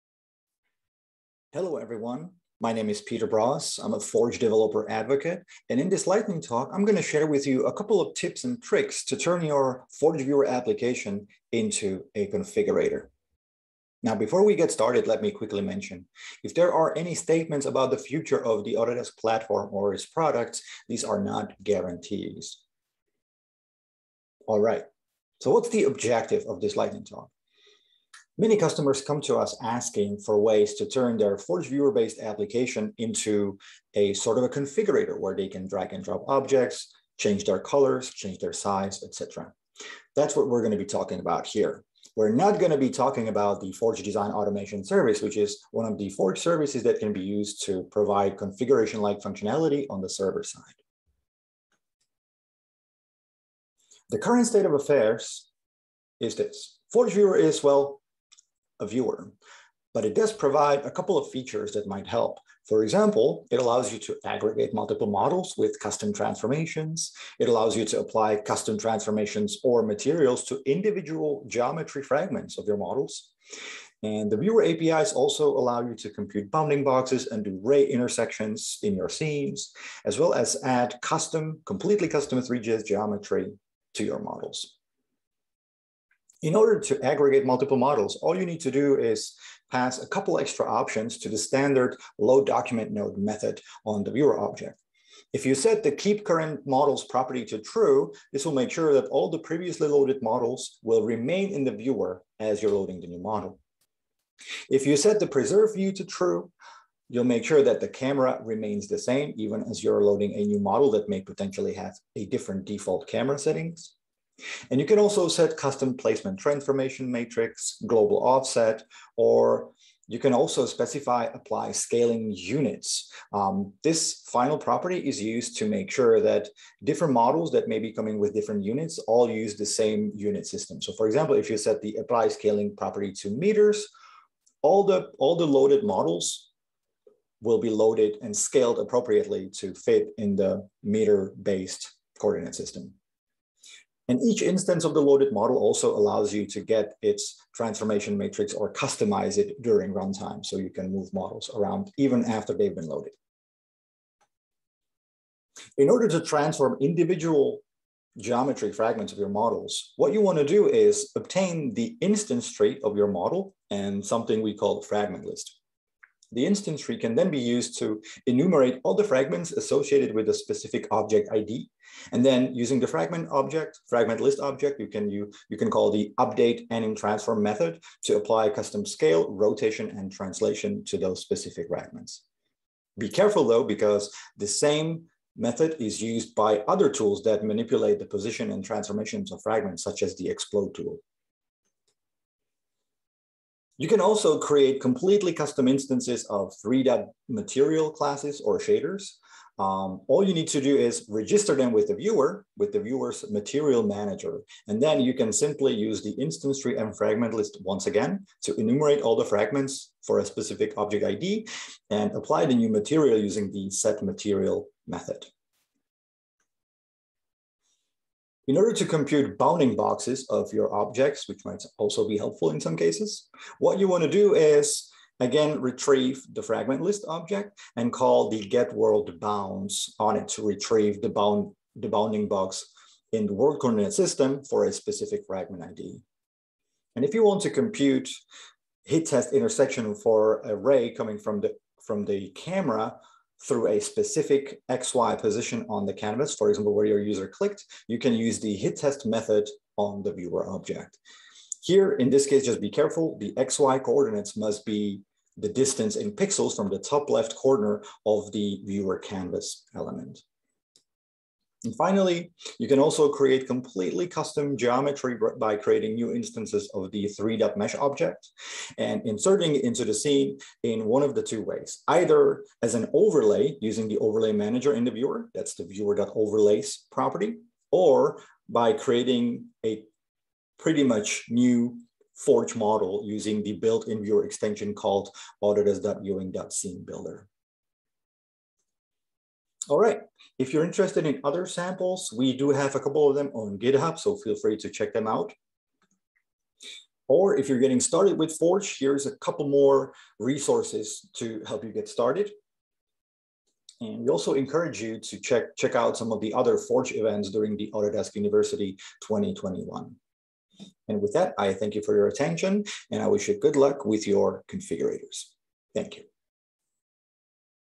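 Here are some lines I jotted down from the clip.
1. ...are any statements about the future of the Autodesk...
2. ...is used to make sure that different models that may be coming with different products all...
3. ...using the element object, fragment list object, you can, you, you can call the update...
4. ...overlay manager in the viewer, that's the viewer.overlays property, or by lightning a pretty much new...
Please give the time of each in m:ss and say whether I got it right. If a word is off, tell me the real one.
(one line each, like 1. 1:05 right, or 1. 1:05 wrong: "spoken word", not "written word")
1. 0:16 right
2. 2:04 wrong: "units", not "products"
3. 2:52 wrong: "fragment", not "element"
4. 4:33 wrong: "creating", not "lightning".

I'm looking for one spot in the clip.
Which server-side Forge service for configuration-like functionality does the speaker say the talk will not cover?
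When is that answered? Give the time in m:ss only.
0:43.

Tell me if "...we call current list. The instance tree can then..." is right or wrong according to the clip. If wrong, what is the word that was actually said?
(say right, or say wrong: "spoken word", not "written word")
wrong: "fragment", not "current".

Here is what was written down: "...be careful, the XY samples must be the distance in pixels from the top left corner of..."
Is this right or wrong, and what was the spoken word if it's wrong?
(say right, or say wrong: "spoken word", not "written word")
wrong: "coordinates", not "samples".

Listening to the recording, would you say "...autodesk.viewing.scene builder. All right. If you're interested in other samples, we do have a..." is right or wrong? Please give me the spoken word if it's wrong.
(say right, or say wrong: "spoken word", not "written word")
right.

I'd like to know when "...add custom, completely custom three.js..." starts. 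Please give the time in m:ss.
1:20.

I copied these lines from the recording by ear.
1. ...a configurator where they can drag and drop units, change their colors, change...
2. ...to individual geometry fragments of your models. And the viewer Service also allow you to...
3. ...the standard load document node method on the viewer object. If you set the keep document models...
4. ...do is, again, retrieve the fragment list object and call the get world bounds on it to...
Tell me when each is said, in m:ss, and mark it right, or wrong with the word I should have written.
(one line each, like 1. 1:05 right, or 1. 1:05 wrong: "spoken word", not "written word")
1. 0:34 wrong: "objects", not "units"
2. 1:10 wrong: "APIs", not "Service"
3. 1:31 wrong: "current", not "document"
4. 3:44 right.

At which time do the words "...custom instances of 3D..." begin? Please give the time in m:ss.
3:15.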